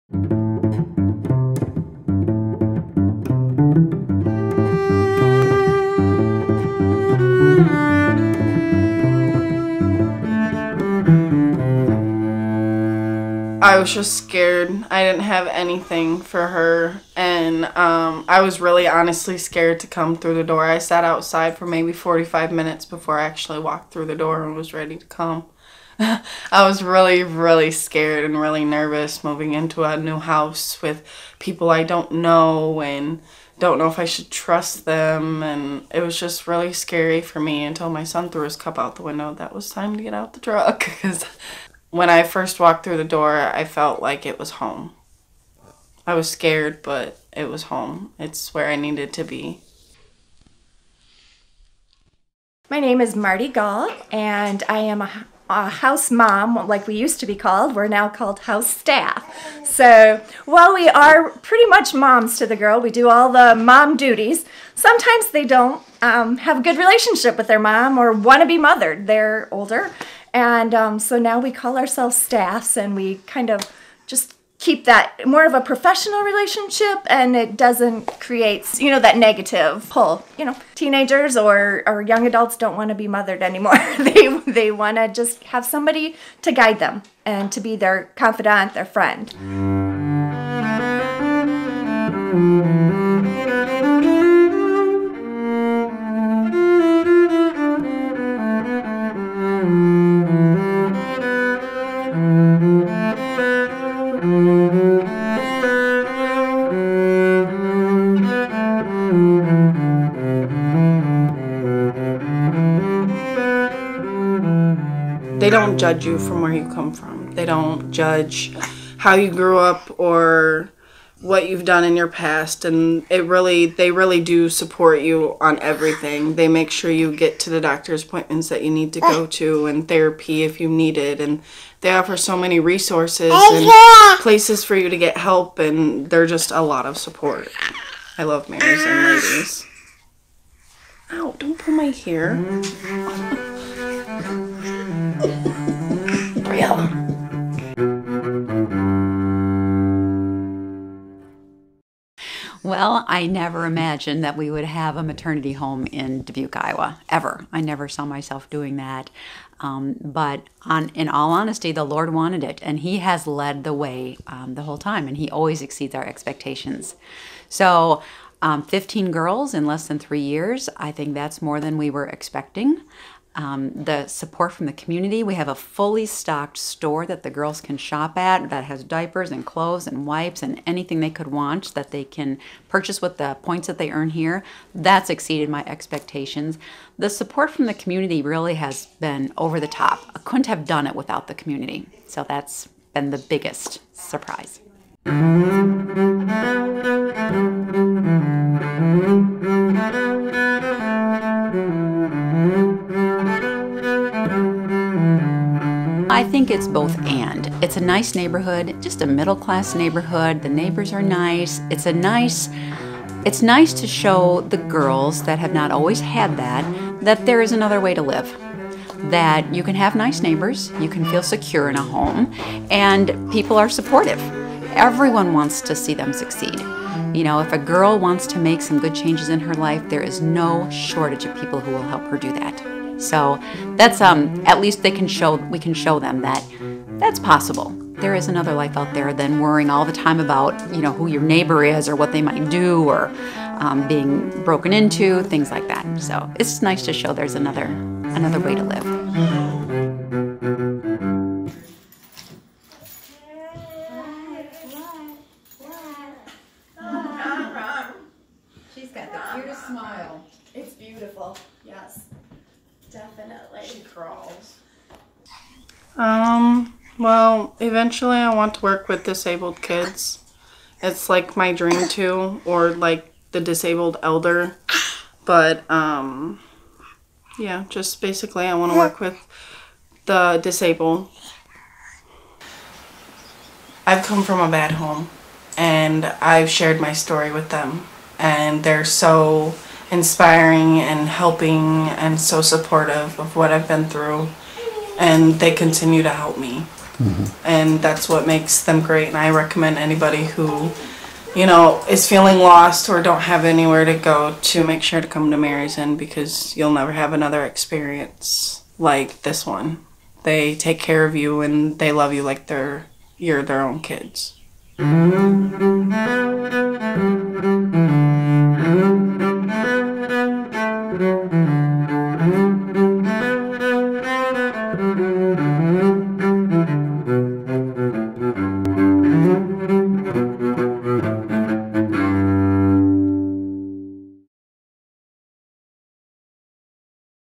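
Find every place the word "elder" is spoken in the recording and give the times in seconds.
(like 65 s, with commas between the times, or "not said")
274 s.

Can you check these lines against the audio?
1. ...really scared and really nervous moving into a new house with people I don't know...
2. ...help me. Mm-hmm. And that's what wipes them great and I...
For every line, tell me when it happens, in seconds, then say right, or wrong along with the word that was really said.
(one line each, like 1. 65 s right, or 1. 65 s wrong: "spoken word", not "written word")
1. 27 s right
2. 296 s wrong: "makes", not "wipes".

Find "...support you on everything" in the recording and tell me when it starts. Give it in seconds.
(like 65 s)
124 s.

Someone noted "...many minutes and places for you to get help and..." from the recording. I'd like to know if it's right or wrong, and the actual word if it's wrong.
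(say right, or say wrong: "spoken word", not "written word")
wrong: "resources", not "minutes".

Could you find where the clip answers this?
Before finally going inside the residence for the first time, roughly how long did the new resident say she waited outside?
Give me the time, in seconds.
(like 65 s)
21 s.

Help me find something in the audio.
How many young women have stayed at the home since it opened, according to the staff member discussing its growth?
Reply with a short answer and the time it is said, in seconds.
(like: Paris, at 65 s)
15, at 168 s.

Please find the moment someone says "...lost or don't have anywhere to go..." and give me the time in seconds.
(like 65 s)
302 s.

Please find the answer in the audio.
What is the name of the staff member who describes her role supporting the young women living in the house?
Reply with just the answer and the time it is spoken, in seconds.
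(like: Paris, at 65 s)
Marti Gaul, at 53 s.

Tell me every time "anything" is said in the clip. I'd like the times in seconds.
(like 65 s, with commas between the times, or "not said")
15 s, 180 s.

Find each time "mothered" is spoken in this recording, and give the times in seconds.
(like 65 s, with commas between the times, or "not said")
68 s, 83 s.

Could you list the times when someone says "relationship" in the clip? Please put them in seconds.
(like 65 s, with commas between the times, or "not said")
66 s, 76 s.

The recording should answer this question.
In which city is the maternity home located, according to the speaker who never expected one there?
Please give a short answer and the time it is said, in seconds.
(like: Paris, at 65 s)
Dubuque, Iowa, at 156 s.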